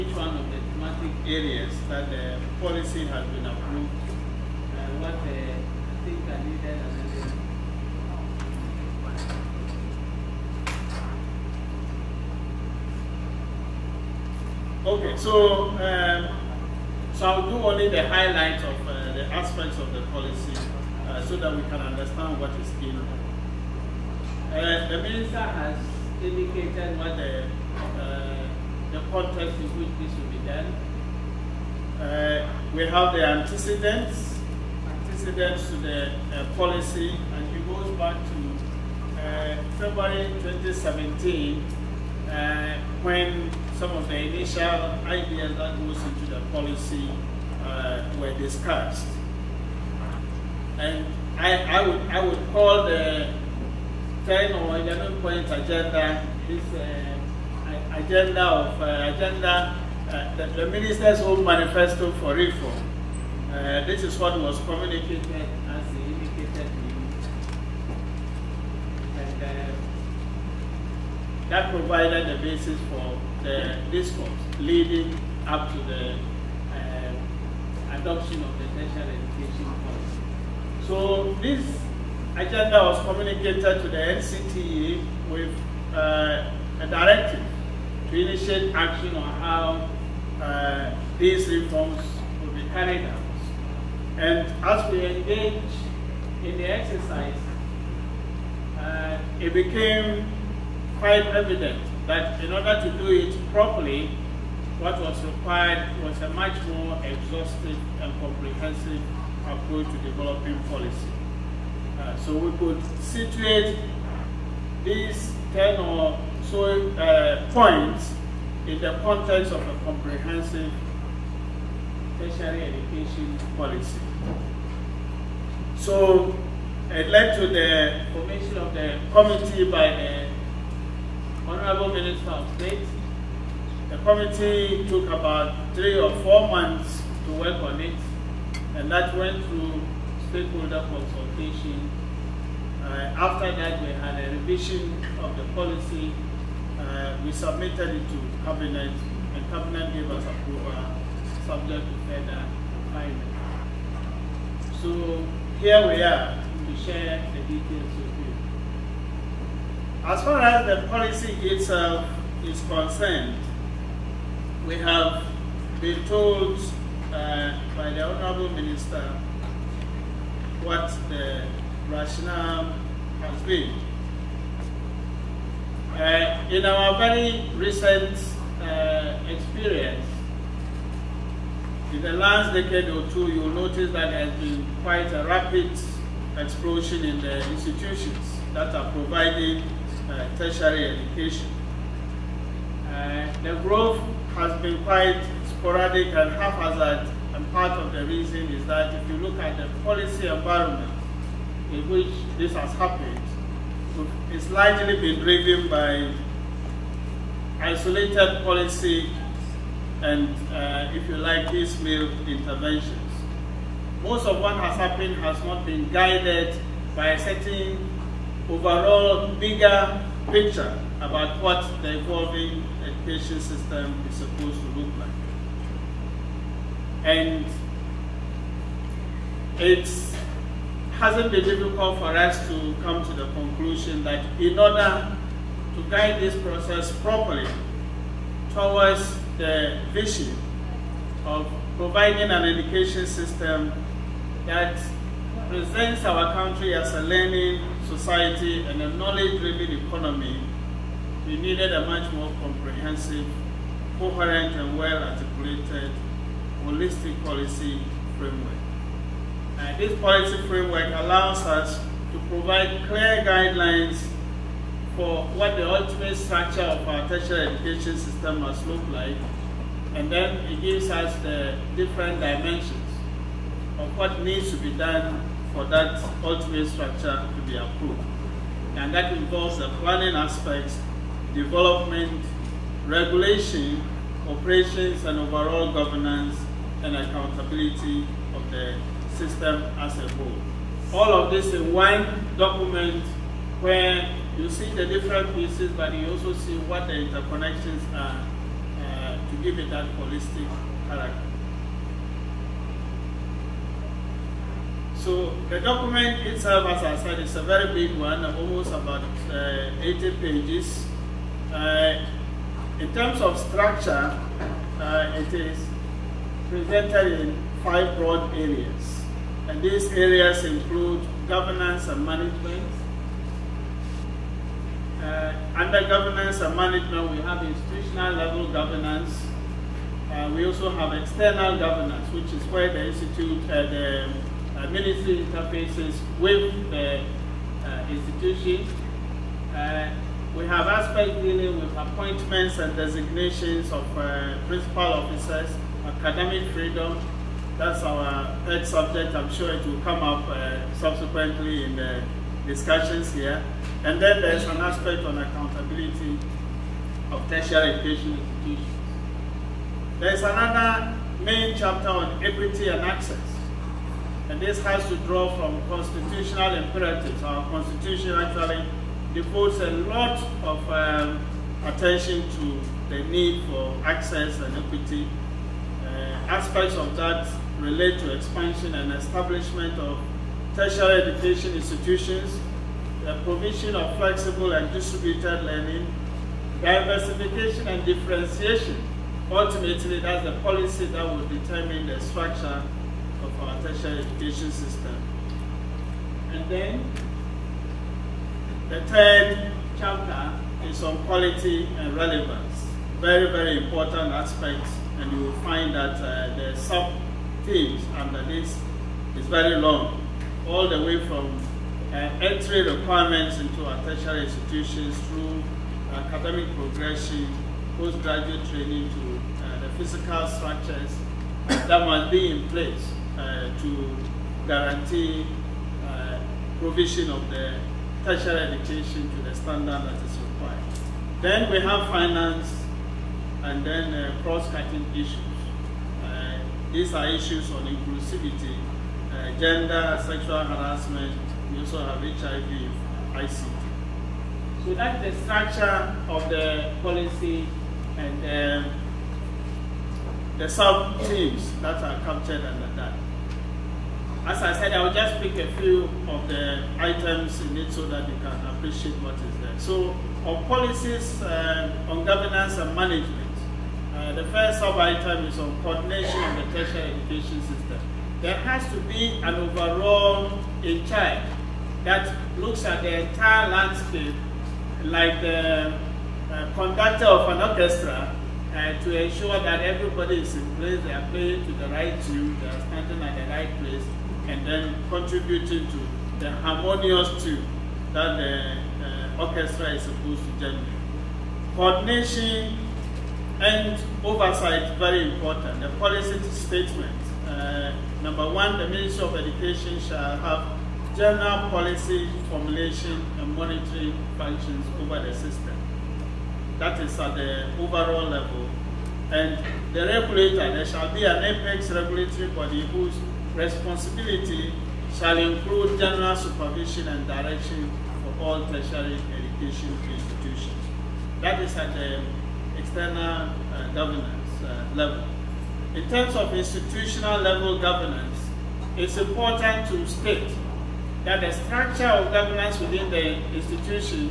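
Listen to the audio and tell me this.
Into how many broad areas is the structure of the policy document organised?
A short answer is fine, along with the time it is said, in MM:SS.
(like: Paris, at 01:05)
five, at 05:17.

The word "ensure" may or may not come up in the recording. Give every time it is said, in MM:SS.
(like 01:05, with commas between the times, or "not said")
07:59.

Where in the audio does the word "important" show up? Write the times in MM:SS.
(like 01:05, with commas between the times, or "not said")
06:43, 08:15, 08:48.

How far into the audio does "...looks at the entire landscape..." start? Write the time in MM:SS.
07:52.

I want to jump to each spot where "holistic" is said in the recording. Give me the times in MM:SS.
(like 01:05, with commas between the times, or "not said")
04:16, 04:59.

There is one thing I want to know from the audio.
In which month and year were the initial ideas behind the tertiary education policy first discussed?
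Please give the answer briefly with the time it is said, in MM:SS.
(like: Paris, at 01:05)
February 2017, at 00:39.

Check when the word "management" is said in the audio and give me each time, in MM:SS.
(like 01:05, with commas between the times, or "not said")
05:22, 05:26, 07:42.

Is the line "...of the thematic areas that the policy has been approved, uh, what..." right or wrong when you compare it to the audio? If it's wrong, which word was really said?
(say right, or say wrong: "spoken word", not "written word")
right.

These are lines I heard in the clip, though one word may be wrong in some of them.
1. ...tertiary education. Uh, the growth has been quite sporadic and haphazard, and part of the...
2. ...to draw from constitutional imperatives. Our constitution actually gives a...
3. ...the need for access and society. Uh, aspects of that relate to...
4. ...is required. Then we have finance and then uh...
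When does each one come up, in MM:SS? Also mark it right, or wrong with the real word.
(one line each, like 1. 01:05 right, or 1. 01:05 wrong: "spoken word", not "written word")
1. 03:10 right
2. 06:04 wrong: "devotes", not "gives"
3. 06:12 wrong: "equity", not "society"
4. 07:09 right.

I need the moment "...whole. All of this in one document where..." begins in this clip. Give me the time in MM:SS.
04:50.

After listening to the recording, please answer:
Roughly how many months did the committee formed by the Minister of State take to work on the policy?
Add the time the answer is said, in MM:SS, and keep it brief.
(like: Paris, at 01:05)
three or four months, at 02:15.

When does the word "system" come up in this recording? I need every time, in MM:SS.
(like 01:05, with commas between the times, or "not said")
03:43, 04:03, 04:27, 04:49, 06:34, 07:47, 08:25.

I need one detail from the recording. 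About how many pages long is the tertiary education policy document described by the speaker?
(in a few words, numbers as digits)
80.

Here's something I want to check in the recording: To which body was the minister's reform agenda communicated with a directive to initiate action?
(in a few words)
NCTE.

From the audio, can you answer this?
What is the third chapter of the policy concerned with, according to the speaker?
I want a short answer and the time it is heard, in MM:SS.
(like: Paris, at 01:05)
quality and relevance, at 06:40.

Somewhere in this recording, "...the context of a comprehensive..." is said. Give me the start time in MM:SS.
01:58.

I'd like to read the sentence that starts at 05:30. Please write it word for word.
Uh, we also have external governance, which is where the institute, uh, the uh, ministry interfaces with the uh, institution.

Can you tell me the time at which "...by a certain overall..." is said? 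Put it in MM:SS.
03:36.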